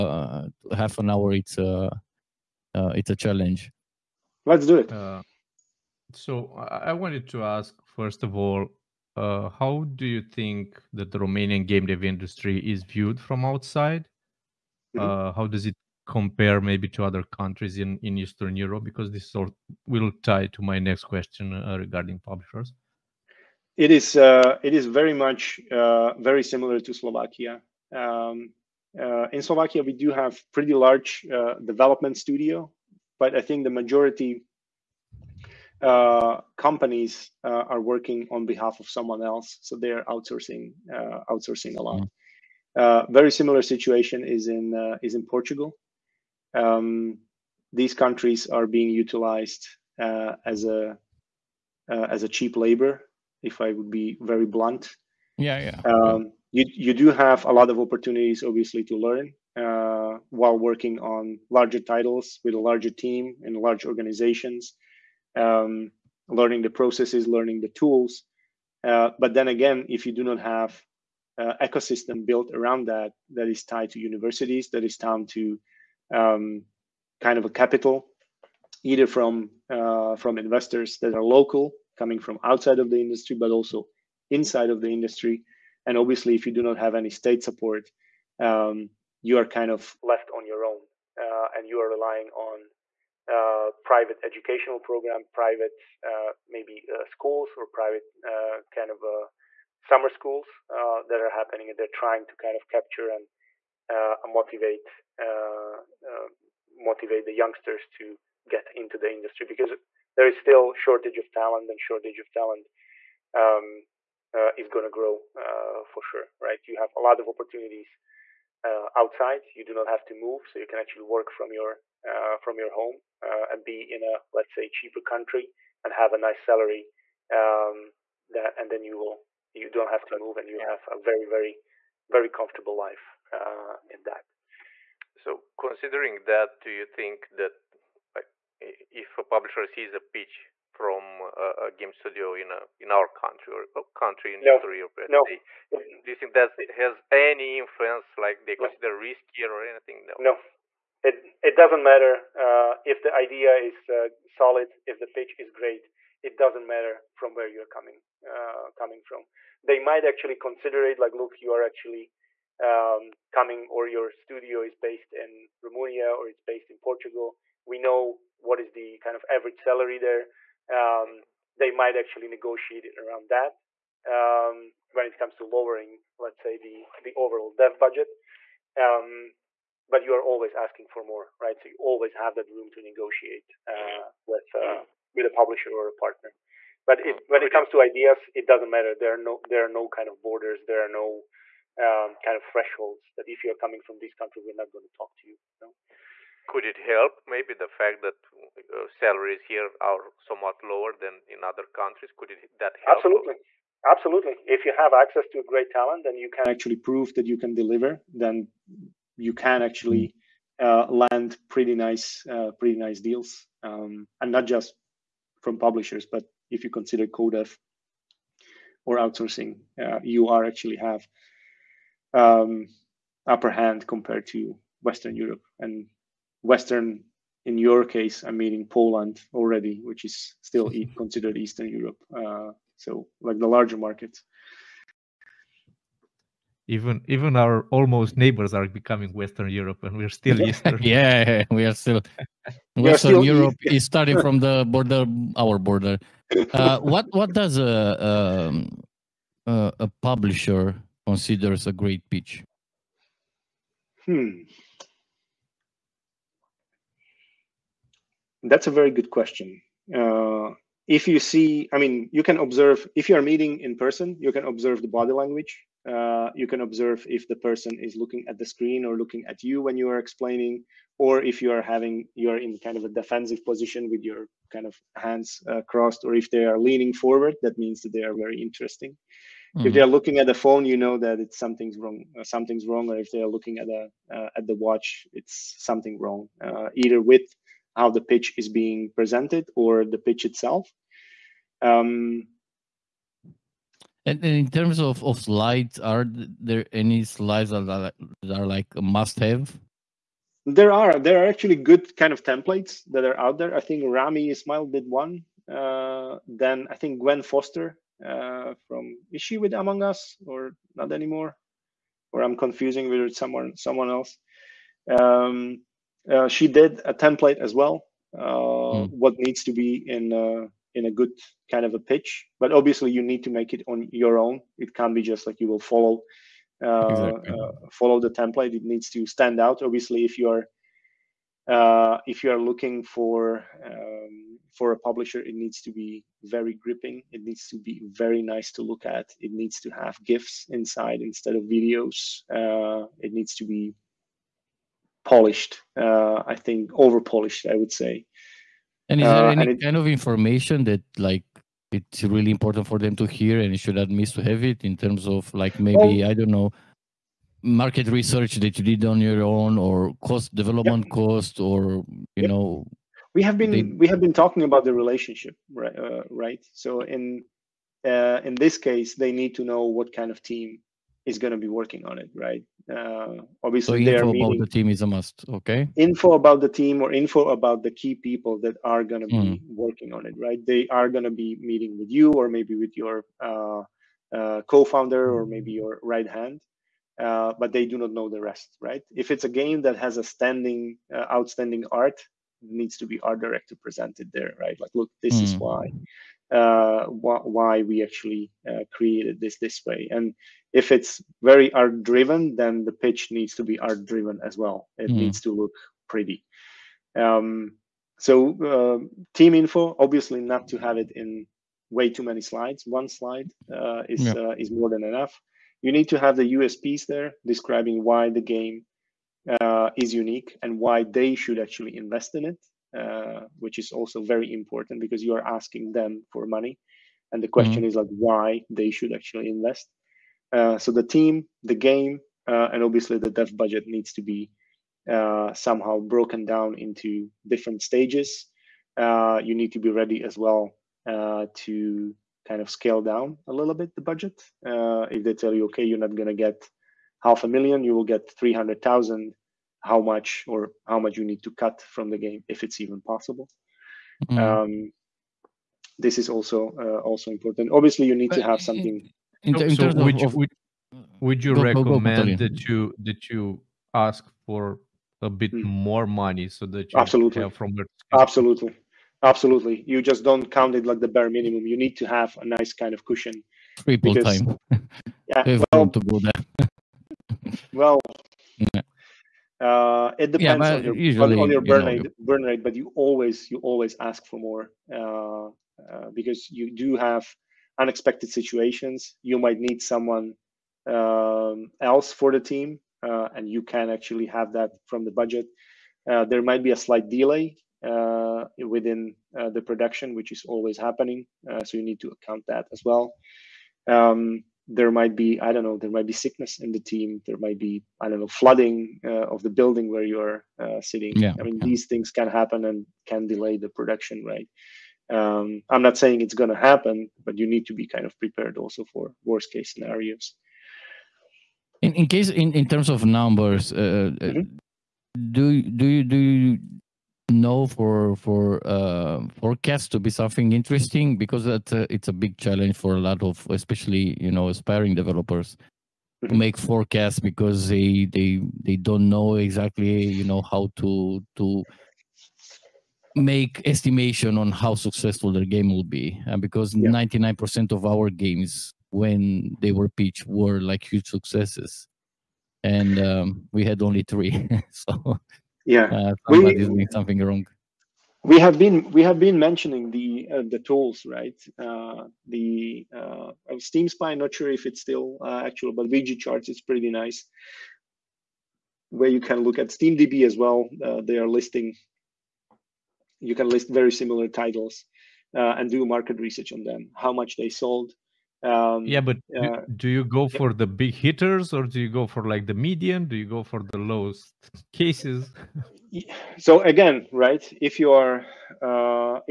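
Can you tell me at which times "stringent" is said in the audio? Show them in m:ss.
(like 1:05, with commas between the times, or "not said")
not said.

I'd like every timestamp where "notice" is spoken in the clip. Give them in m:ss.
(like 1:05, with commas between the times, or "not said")
not said.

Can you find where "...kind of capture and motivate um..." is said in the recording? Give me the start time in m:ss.
1:42.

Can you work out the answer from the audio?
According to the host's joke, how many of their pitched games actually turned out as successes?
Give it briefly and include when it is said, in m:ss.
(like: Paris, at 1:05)
Three, at 9:13.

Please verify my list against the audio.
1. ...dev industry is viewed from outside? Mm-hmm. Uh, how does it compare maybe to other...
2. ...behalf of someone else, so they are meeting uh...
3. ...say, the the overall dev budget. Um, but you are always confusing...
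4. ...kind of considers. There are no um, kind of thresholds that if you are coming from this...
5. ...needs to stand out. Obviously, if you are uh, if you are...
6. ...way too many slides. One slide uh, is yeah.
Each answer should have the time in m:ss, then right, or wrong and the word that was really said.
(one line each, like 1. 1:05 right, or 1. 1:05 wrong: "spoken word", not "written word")
1. 0:11 right
2. 0:38 wrong: "outsourcing", not "meeting"
3. 2:56 wrong: "asking", not "confusing"
4. 3:09 wrong: "borders", not "considers"
5. 5:28 right
6. 6:51 right.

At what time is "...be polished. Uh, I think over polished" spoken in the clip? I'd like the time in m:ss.
5:43.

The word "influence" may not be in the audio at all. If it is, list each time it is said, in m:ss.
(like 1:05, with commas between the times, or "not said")
2:27.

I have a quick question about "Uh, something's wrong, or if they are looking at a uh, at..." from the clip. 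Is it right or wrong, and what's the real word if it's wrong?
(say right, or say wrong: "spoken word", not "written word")
right.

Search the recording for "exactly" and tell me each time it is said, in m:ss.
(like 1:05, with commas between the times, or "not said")
5:26, 8:59.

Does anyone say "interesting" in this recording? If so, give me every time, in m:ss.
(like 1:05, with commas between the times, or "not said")
4:38, 8:50.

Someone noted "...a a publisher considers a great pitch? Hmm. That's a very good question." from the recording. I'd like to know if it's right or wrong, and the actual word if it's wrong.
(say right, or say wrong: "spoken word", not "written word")
right.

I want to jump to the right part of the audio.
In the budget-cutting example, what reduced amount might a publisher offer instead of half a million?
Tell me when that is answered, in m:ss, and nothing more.
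7:28.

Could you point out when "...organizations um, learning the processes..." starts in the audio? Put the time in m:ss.
1:03.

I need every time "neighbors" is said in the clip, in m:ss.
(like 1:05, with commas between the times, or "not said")
3:58.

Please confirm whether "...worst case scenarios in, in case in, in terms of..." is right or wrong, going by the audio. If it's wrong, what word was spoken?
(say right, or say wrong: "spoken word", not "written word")
right.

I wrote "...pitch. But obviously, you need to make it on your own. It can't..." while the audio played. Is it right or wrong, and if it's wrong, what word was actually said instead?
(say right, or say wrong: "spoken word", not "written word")
right.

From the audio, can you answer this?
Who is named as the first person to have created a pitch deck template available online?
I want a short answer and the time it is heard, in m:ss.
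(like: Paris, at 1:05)
Rami Ismail, at 5:03.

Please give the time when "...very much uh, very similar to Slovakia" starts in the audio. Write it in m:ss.
0:24.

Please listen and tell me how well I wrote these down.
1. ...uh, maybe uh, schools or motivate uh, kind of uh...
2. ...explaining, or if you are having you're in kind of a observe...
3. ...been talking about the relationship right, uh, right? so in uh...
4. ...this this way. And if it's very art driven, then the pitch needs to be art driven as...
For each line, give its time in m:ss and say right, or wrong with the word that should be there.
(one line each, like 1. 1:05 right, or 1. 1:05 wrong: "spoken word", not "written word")
1. 1:36 wrong: "private", not "motivate"
2. 4:29 wrong: "defensive", not "observe"
3. 6:03 right
4. 6:39 right.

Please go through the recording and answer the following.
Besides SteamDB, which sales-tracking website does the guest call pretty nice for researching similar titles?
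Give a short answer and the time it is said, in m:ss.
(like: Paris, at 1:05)
VG Charts, at 9:25.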